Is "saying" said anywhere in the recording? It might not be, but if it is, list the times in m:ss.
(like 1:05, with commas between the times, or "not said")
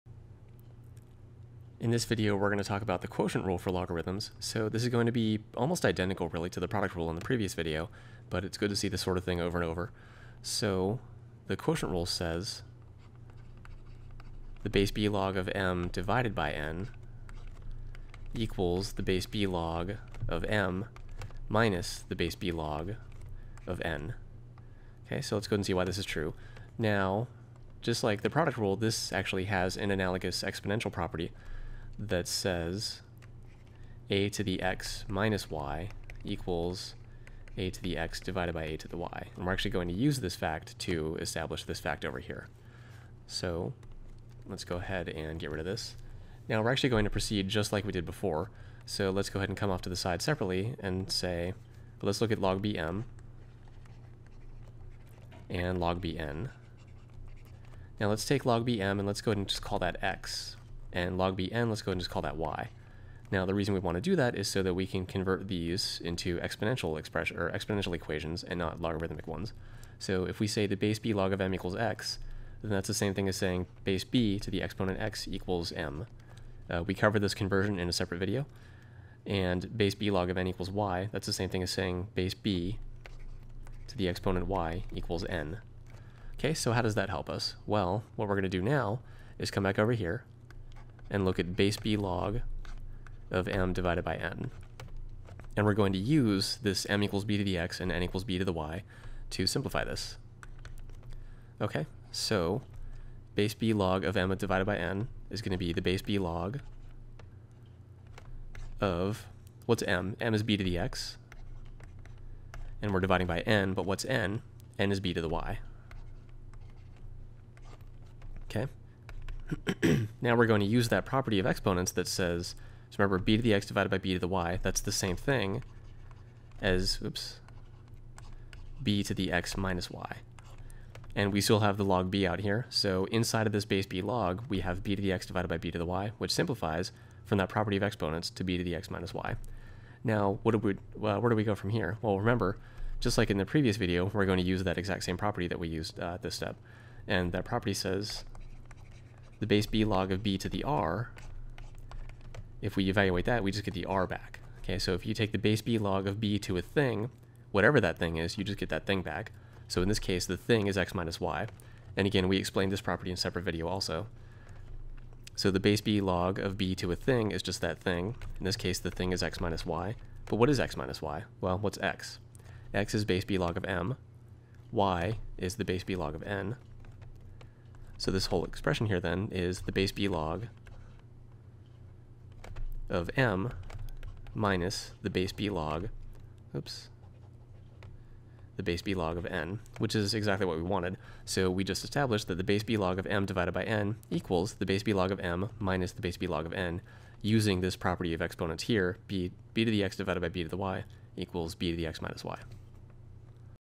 1:13, 1:21.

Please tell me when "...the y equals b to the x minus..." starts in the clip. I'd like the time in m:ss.
3:20.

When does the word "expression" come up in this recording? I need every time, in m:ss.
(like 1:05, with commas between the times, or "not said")
1:06, 2:58.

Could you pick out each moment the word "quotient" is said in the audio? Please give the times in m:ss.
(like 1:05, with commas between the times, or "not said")
0:03, 0:11.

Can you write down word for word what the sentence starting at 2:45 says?
So the base b log of b to a thing is just that thing.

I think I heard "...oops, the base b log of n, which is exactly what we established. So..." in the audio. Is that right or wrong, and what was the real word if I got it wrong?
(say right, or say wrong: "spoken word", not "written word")
wrong: "wanted", not "established".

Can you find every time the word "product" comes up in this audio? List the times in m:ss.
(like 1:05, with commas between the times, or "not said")
0:06, 0:28.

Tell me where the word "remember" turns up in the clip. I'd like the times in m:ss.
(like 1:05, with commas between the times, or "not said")
2:02, 2:22.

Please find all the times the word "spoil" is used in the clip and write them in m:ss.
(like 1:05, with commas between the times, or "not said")
not said.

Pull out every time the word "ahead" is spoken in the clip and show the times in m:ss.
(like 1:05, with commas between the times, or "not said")
0:44, 0:49, 0:59.